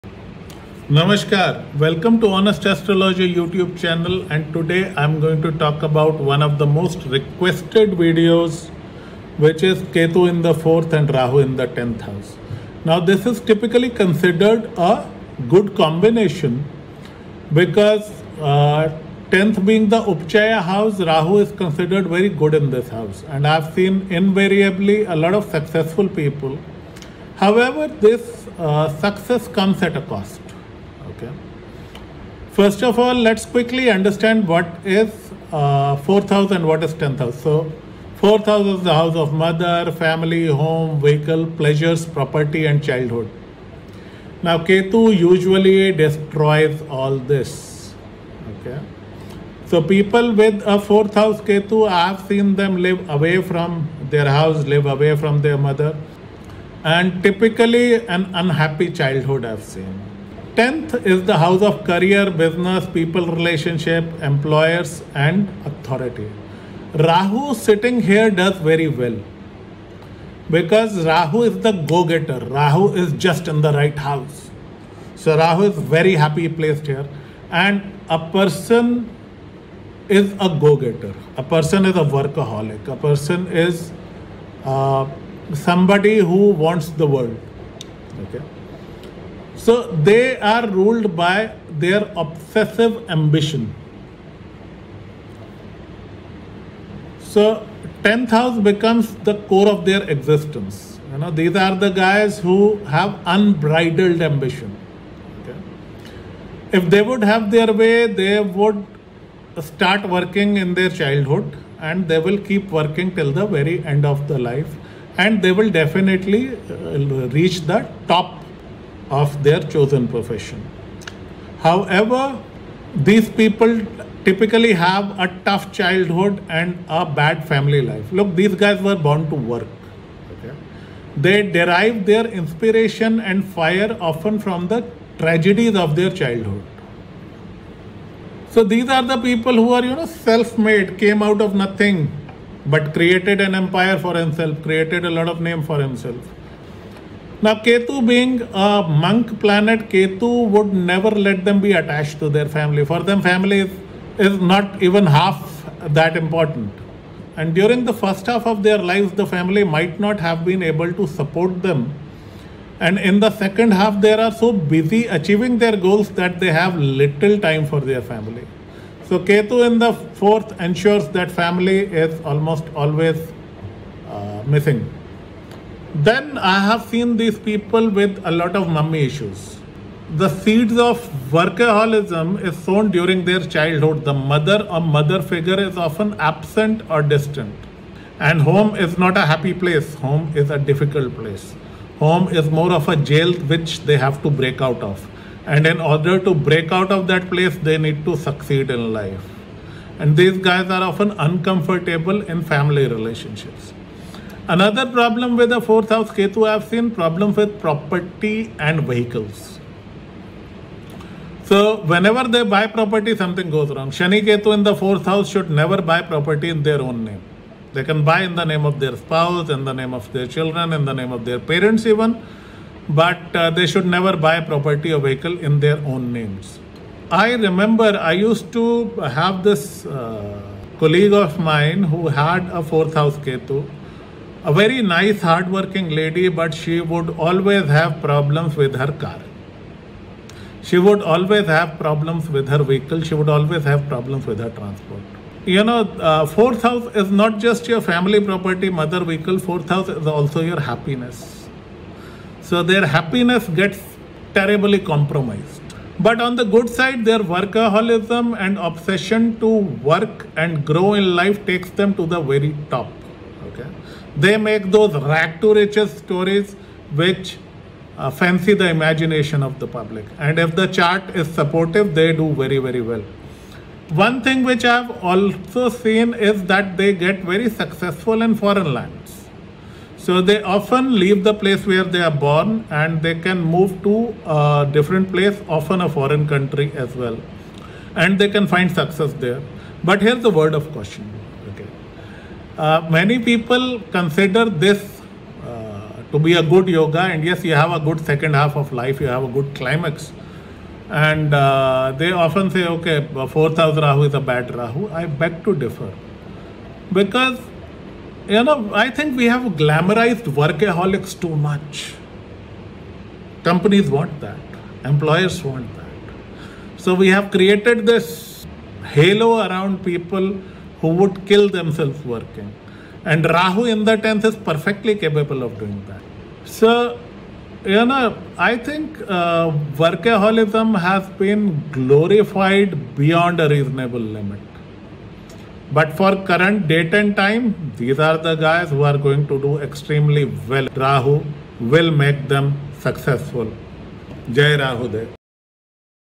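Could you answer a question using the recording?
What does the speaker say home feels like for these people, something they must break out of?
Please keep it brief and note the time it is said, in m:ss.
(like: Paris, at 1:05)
a jail, at 3:12.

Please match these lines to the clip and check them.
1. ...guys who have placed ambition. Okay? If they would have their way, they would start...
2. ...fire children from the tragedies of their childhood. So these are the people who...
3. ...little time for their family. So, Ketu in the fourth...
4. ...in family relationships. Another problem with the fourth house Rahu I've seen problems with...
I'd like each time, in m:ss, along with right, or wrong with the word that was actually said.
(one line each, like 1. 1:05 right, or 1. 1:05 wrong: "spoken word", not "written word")
1. 1:41 wrong: "unbridled", not "placed"
2. 2:13 wrong: "often", not "children"
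3. 2:46 right
4. 3:22 wrong: "Ketu", not "Rahu".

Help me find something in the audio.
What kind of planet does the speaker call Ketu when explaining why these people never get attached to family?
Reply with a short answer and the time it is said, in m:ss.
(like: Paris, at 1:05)
monk planet, at 2:28.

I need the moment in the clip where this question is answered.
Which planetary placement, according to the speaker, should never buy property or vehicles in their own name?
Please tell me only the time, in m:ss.
3:33.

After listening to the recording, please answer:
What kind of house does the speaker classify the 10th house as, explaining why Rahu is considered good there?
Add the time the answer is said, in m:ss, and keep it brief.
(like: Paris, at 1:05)
Upchaya house, at 0:20.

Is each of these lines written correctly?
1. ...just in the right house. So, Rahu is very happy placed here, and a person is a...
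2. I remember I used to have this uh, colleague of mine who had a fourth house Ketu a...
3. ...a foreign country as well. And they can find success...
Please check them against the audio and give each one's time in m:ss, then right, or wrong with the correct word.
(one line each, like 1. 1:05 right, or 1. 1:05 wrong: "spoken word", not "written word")
1. 1:13 right
2. 3:47 right
3. 4:45 right.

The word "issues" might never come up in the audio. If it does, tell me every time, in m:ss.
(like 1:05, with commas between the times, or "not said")
2:59.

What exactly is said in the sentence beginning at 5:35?
But for current date and time, these are the guys who are going to do extremely well.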